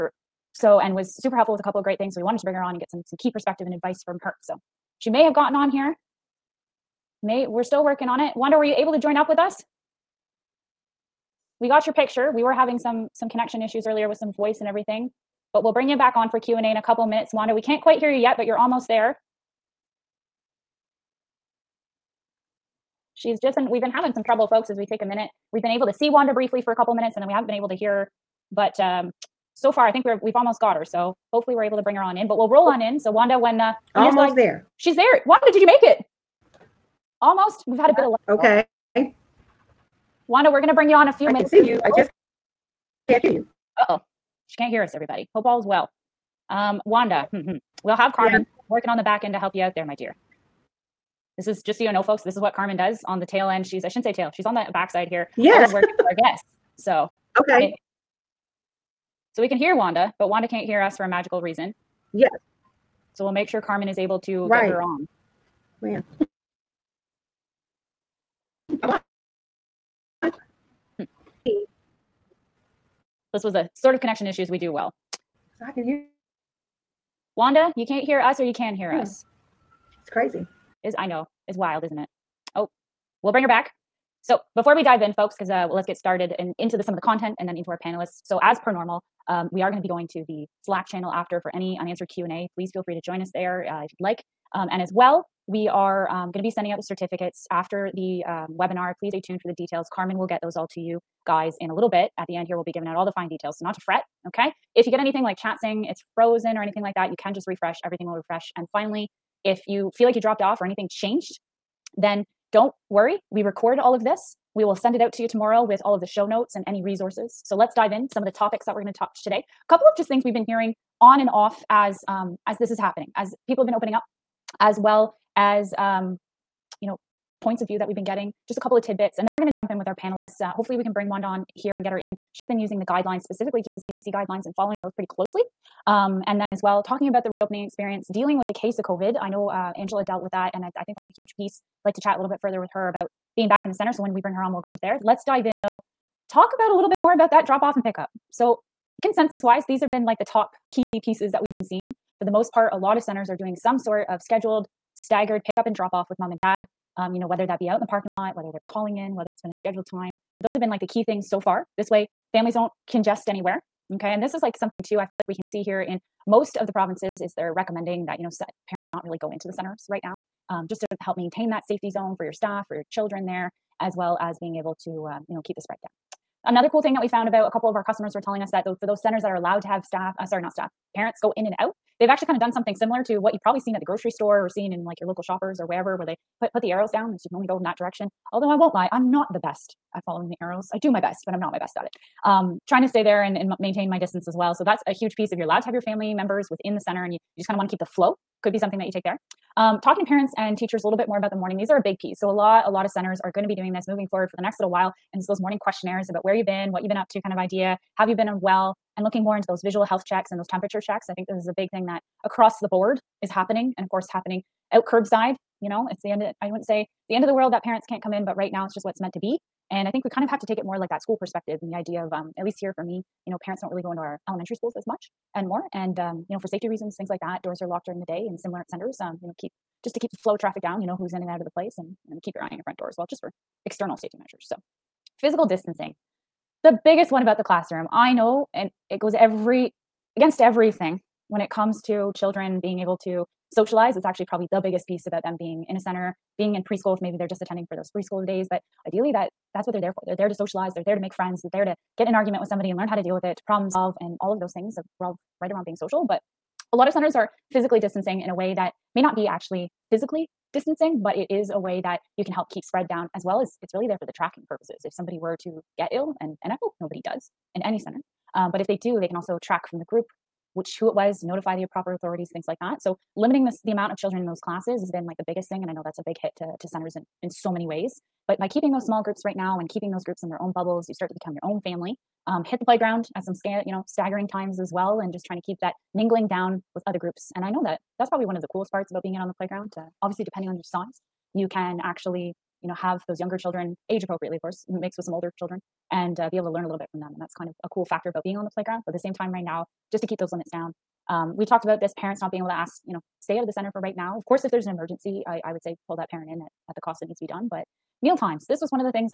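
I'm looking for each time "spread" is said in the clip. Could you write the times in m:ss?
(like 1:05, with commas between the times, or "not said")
2:55, 4:22.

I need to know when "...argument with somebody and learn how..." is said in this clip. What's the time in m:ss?
4:12.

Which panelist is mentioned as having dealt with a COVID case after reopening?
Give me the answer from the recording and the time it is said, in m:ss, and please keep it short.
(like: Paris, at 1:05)
Angela, at 2:19.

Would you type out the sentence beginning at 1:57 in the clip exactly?
So let's dive in some of the topics that we're going to touch today.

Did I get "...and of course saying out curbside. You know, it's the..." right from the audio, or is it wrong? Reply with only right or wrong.
wrong.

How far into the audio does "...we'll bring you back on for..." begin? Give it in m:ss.
0:15.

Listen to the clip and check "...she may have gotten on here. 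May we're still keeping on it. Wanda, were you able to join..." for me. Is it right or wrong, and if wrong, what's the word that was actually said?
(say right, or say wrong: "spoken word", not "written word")
wrong: "working", not "keeping".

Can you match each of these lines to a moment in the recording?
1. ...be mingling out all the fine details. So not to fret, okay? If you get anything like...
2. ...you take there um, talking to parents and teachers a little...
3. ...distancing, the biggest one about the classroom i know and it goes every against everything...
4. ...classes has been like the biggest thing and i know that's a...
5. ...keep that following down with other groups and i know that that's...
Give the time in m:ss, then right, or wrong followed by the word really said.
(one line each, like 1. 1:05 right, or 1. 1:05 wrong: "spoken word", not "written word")
1. 1:42 wrong: "giving", not "mingling"
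2. 3:18 right
3. 3:55 right
4. 4:34 right
5. 4:45 wrong: "mingling", not "following".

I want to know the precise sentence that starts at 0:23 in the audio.
She's just been, we've been having some trouble, folks, as we take a minute.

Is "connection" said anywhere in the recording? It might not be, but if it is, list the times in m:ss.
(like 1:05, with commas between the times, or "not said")
0:13, 1:13.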